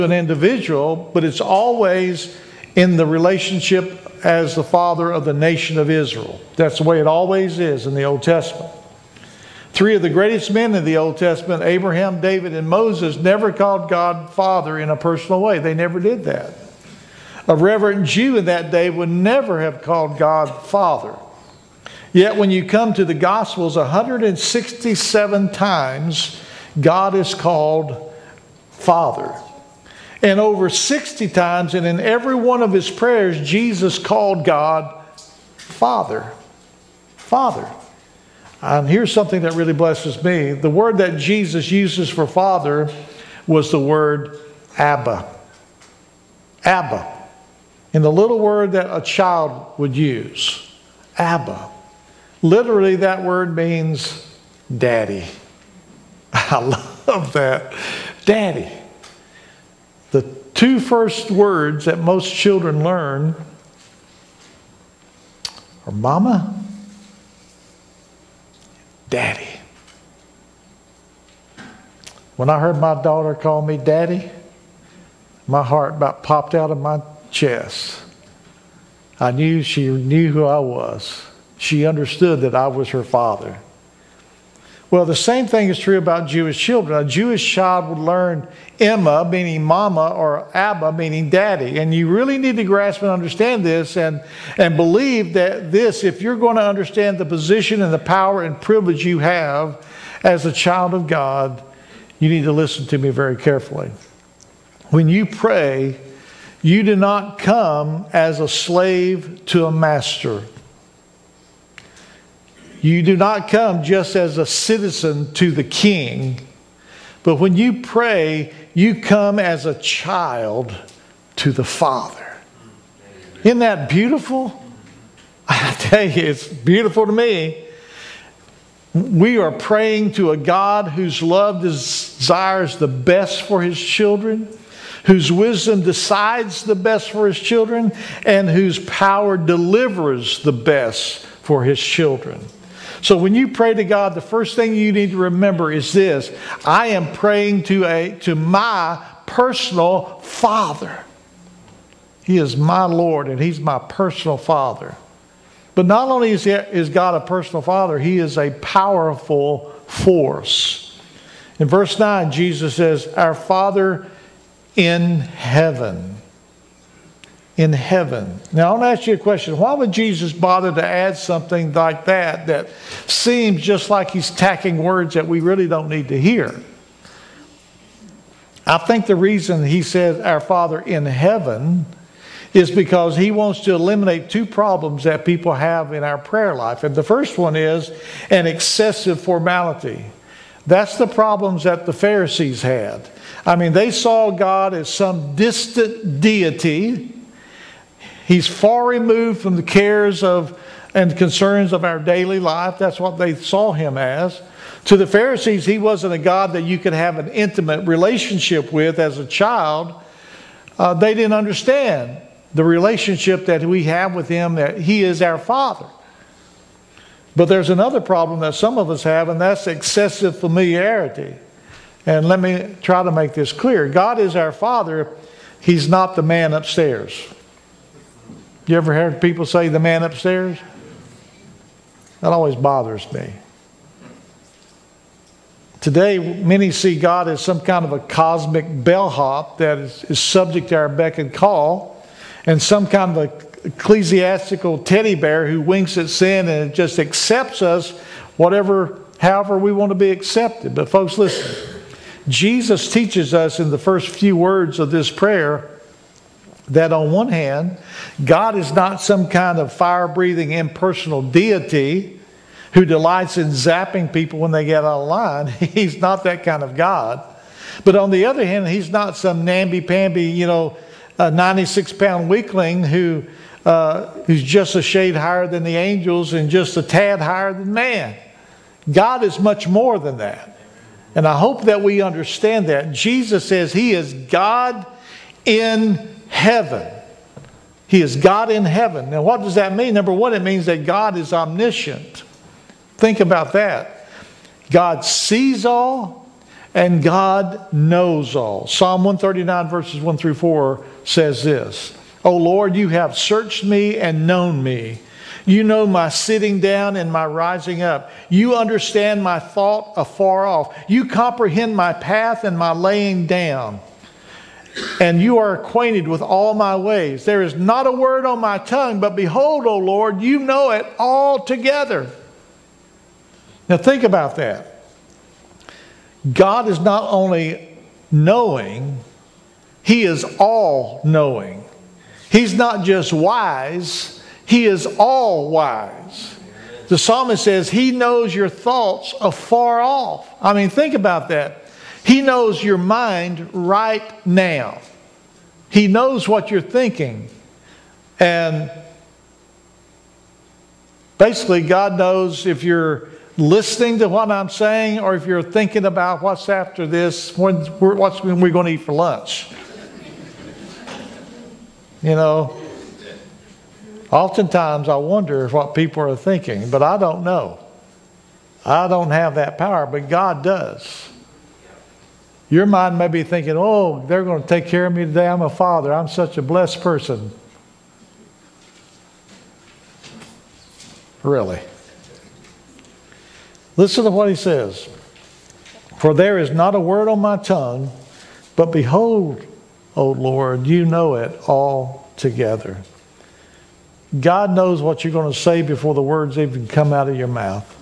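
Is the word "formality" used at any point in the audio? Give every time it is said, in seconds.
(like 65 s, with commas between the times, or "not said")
189 s.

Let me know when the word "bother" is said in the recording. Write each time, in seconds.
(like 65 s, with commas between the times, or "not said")
170 s, 232 s.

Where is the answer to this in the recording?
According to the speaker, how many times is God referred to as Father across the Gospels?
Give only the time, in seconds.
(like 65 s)
23 s.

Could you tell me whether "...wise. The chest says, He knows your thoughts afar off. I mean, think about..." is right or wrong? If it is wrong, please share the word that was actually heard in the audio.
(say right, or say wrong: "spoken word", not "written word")
wrong: "psalmist", not "chest".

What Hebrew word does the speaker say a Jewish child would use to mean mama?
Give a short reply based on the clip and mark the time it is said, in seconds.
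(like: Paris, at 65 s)
Emma, at 88 s.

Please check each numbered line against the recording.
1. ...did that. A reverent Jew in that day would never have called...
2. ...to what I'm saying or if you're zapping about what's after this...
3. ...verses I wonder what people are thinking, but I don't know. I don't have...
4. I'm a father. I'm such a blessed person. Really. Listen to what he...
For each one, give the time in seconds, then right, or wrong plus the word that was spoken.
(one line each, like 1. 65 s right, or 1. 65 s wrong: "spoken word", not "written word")
1. 16 s right
2. 353 s wrong: "thinking", not "zapping"
3. 364 s wrong: "oftentimes", not "verses"
4. 375 s right.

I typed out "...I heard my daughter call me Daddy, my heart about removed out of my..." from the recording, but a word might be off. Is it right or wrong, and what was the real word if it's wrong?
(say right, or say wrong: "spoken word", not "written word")
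wrong: "popped", not "removed".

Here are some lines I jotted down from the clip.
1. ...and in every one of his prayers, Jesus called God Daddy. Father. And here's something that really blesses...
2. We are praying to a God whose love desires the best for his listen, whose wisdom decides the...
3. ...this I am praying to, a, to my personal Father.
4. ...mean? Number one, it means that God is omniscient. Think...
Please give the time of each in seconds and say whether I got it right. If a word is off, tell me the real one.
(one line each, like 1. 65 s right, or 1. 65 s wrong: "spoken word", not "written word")
1. 31 s wrong: "Father", not "Daddy"
2. 128 s wrong: "children", not "listen"
3. 145 s right
4. 289 s right.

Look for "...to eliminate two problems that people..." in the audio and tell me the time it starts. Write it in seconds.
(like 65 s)
183 s.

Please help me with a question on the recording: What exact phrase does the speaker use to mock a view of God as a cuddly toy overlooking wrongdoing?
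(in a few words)
Ecclesiastical teddy bear.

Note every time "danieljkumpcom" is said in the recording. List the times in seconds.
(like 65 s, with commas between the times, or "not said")
not said.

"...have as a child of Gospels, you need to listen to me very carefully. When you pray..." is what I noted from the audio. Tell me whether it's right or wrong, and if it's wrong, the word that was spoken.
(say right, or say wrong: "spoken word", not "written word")
wrong: "God", not "Gospels".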